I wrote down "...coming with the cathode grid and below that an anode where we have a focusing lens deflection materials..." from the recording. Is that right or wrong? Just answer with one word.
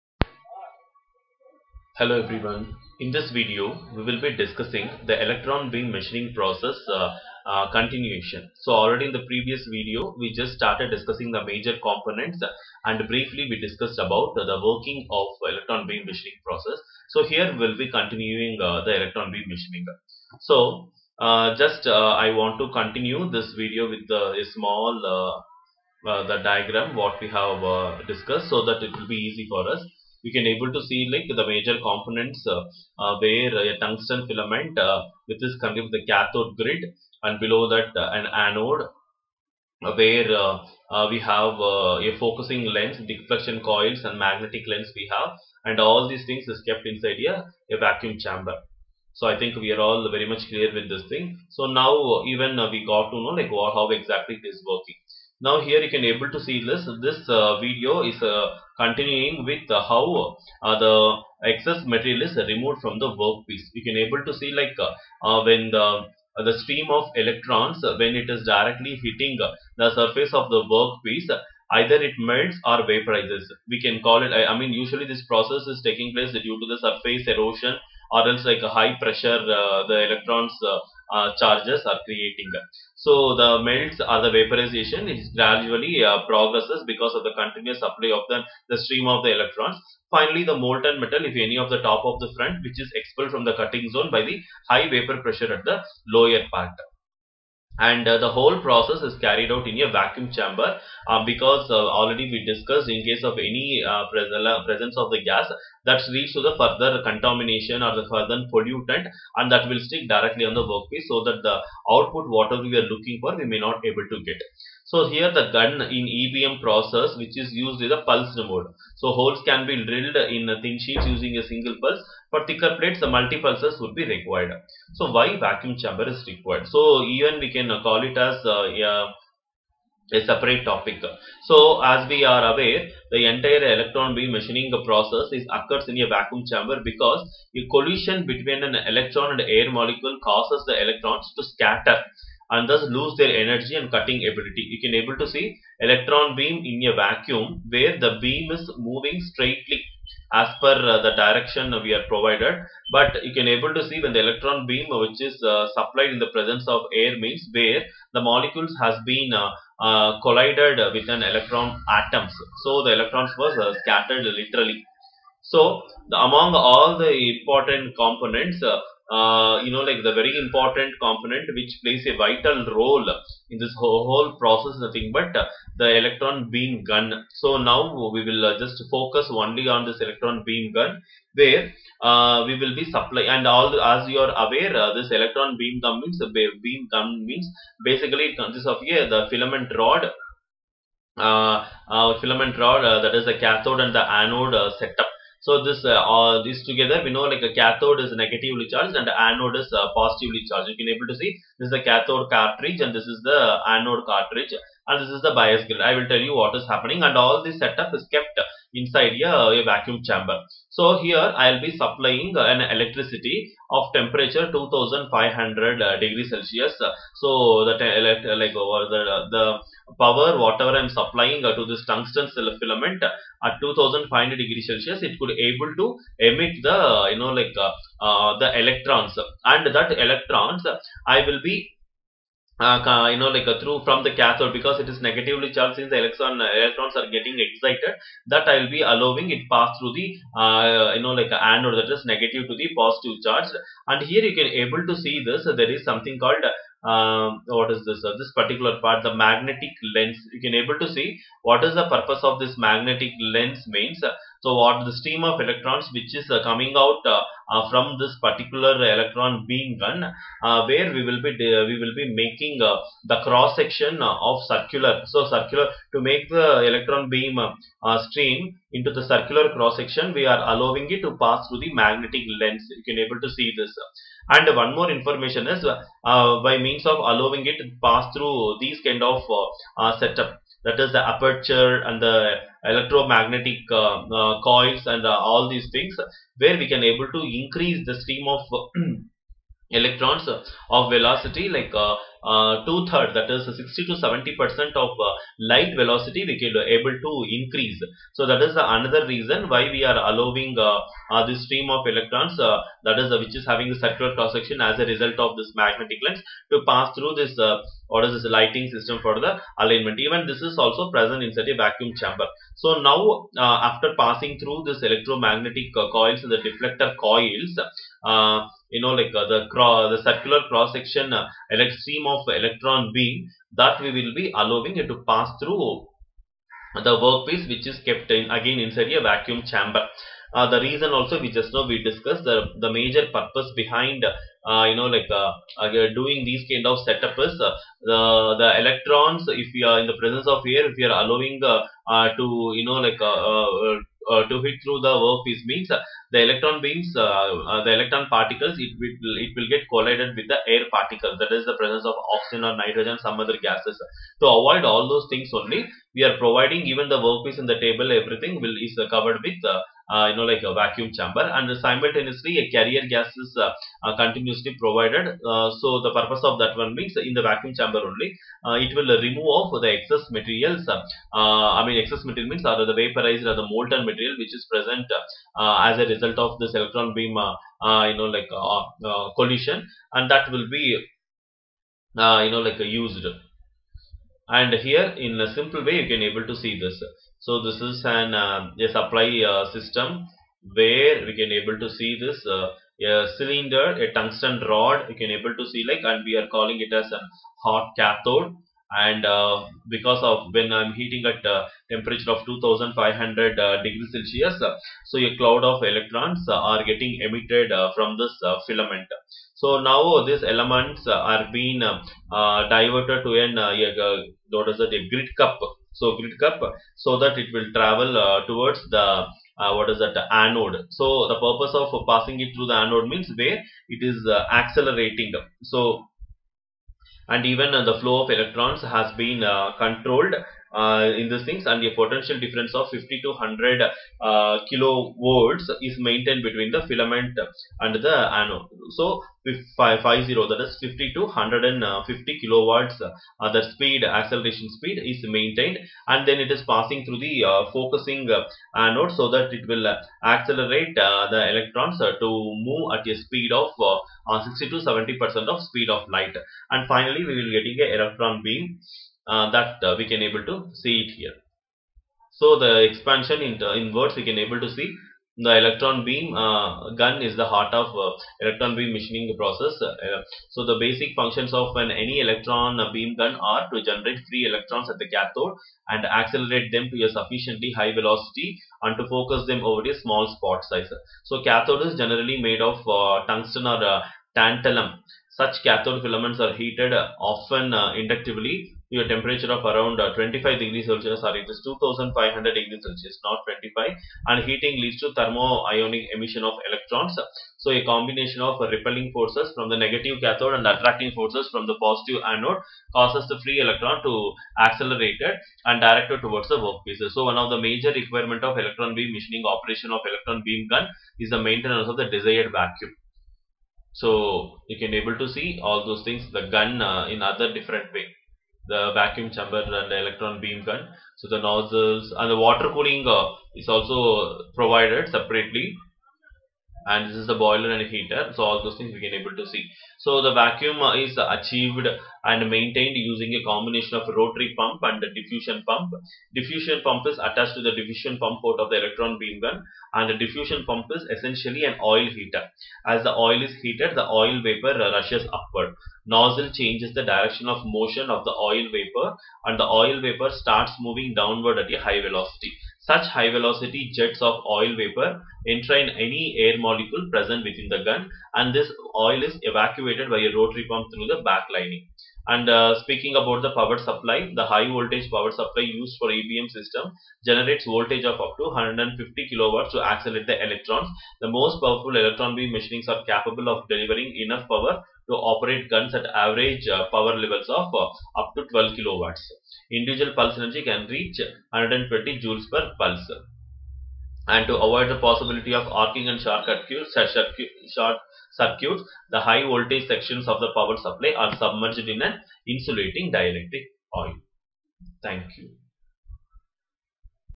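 wrong.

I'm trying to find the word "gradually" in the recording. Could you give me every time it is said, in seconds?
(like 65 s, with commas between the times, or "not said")
85 s.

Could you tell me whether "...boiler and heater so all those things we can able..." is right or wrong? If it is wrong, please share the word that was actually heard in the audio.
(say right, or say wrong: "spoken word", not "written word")
right.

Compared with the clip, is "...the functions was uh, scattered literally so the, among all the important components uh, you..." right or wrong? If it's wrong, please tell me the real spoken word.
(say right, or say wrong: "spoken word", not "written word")
wrong: "electrons", not "functions".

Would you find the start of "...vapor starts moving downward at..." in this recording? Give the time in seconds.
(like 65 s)
549 s.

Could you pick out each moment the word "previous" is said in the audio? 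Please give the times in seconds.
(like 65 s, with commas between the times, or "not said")
9 s.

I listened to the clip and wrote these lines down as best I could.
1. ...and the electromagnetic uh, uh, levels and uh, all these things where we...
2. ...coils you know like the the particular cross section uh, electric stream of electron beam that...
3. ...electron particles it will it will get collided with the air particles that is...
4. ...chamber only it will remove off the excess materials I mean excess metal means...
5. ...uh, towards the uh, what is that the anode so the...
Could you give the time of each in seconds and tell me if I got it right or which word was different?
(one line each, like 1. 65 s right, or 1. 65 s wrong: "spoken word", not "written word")
1. 281 s wrong: "coils", not "levels"
2. 317 s wrong: "circular", not "particular"
3. 347 s right
4. 367 s wrong: "material", not "metal"
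5. 417 s right.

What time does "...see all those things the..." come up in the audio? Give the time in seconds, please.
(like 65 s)
515 s.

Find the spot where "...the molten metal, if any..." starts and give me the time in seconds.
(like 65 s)
90 s.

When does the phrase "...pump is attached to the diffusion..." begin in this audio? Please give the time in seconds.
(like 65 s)
536 s.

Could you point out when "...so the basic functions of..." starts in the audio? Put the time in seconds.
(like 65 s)
470 s.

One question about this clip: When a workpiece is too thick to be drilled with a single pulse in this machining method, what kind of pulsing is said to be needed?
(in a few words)
Multi pulses.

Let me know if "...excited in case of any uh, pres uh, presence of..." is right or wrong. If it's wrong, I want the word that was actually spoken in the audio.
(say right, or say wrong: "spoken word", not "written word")
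wrong: "discussed", not "excited".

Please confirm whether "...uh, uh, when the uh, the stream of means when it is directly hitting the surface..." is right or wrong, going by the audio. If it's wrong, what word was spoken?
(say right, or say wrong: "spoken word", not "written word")
wrong: "electrons", not "means".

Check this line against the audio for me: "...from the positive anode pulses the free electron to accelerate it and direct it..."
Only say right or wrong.
wrong.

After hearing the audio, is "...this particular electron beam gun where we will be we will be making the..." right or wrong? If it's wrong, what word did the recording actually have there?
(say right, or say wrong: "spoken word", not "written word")
right.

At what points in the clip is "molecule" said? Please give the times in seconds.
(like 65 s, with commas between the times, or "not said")
139 s, 158 s, 556 s.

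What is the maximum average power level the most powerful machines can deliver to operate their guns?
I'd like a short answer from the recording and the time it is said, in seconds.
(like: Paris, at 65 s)
12 kilowatts, at 578 s.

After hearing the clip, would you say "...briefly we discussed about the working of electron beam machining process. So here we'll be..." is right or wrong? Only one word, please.
right.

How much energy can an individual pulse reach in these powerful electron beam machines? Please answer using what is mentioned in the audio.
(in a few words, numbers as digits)
120 joules.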